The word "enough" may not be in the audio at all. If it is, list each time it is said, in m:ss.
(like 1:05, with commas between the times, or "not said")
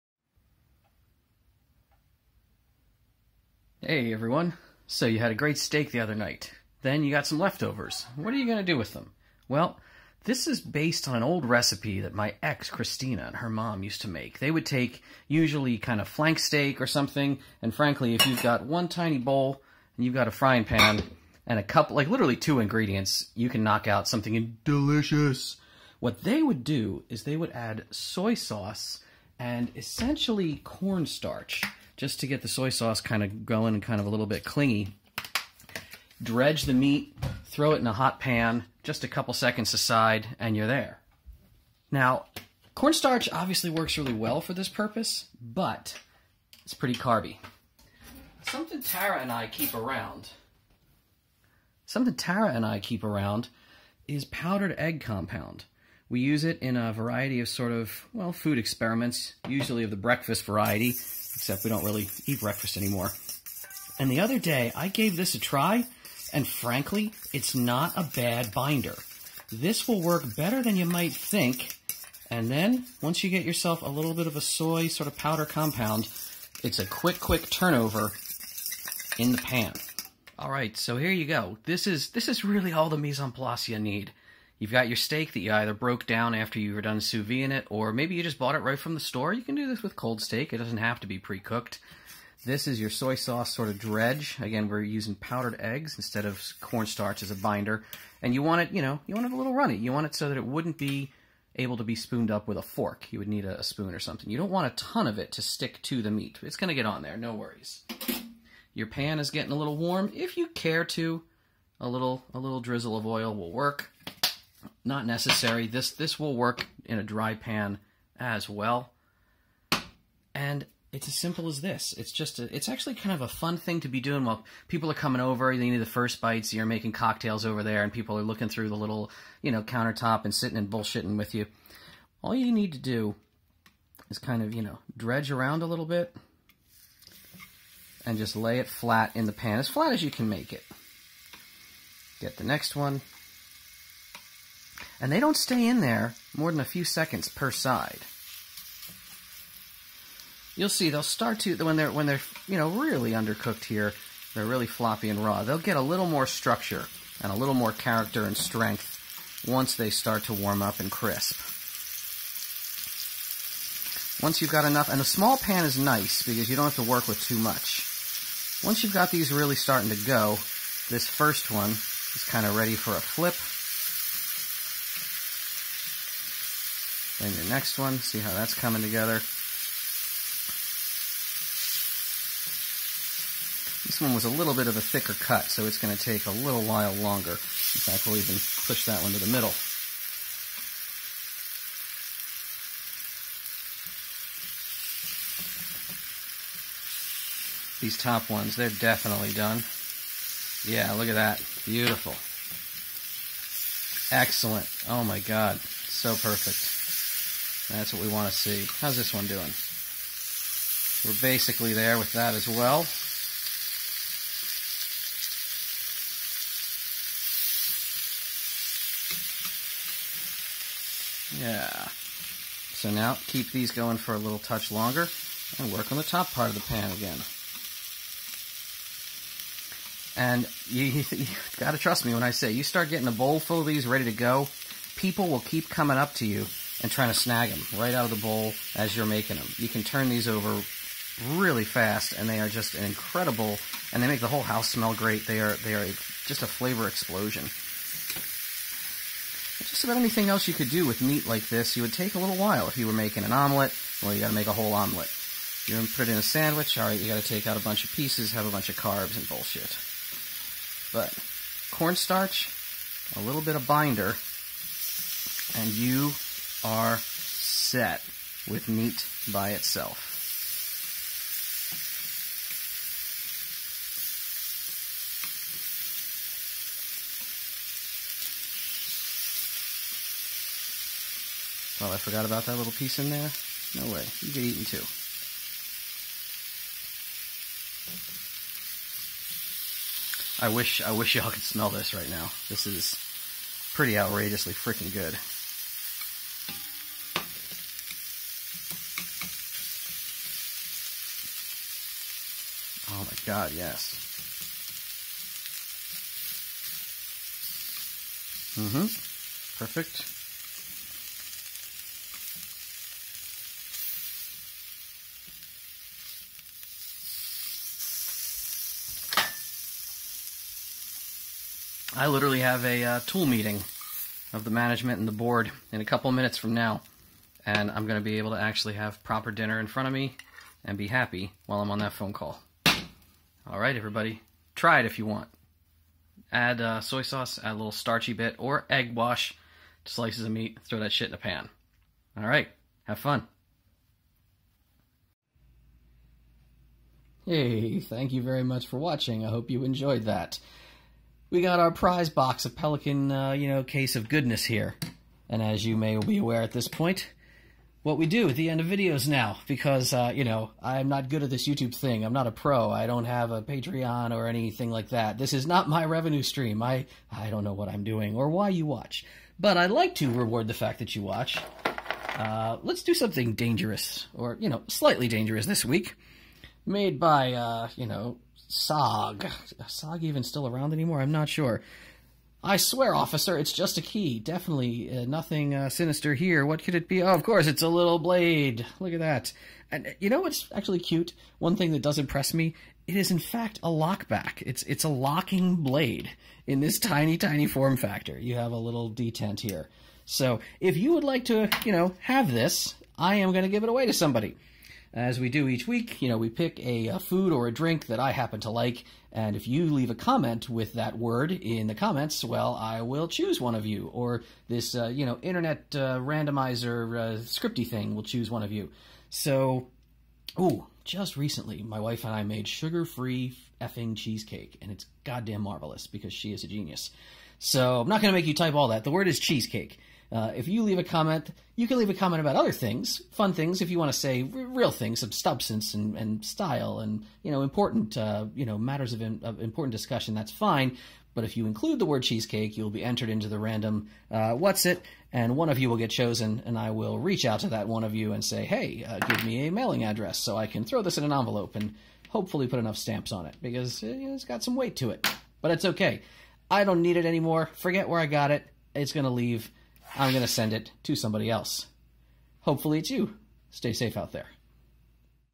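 2:44, 7:32.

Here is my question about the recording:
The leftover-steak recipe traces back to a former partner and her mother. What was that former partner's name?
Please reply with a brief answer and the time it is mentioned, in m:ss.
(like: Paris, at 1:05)
Christina, at 0:12.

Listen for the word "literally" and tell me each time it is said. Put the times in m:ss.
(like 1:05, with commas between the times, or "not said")
0:22, 5:22.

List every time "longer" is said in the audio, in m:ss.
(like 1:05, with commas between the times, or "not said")
3:06, 3:44.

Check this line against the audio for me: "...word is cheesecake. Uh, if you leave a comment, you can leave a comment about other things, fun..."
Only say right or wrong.
right.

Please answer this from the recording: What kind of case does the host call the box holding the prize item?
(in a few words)
Pelican.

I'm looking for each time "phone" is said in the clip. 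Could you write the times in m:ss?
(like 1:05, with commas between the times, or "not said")
5:31.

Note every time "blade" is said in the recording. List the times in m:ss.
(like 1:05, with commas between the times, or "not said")
6:27, 6:35.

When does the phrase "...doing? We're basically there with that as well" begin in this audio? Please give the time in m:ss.
3:29.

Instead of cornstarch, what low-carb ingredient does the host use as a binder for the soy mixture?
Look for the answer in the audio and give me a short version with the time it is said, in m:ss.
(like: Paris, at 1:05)
Powdered egg, at 0:54.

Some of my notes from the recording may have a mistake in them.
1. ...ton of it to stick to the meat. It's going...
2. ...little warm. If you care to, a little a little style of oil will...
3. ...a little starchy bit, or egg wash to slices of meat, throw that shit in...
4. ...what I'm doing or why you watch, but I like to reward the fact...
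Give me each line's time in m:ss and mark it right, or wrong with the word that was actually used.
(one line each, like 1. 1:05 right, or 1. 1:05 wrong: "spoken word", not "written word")
1. 1:44 right
2. 1:49 wrong: "drizzle", not "style"
3. 5:37 right
4. 6:07 right.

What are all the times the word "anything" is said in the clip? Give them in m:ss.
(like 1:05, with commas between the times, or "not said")
4:09, 6:04.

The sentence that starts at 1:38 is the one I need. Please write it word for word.
And you want it, you know, you want it a little runny.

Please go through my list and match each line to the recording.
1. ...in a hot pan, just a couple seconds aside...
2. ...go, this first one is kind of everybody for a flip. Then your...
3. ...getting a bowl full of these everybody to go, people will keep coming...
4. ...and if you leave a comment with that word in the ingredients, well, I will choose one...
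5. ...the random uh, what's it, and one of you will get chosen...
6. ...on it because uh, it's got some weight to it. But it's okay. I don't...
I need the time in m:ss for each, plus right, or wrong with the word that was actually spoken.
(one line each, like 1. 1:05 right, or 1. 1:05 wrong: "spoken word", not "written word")
1. 0:37 right
2. 2:50 wrong: "ready", not "everybody"
3. 3:52 wrong: "ready", not "everybody"
4. 6:49 wrong: "comments", not "ingredients"
5. 7:23 right
6. 7:33 right.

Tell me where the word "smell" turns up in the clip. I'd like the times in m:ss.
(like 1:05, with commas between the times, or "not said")
4:04, 4:51.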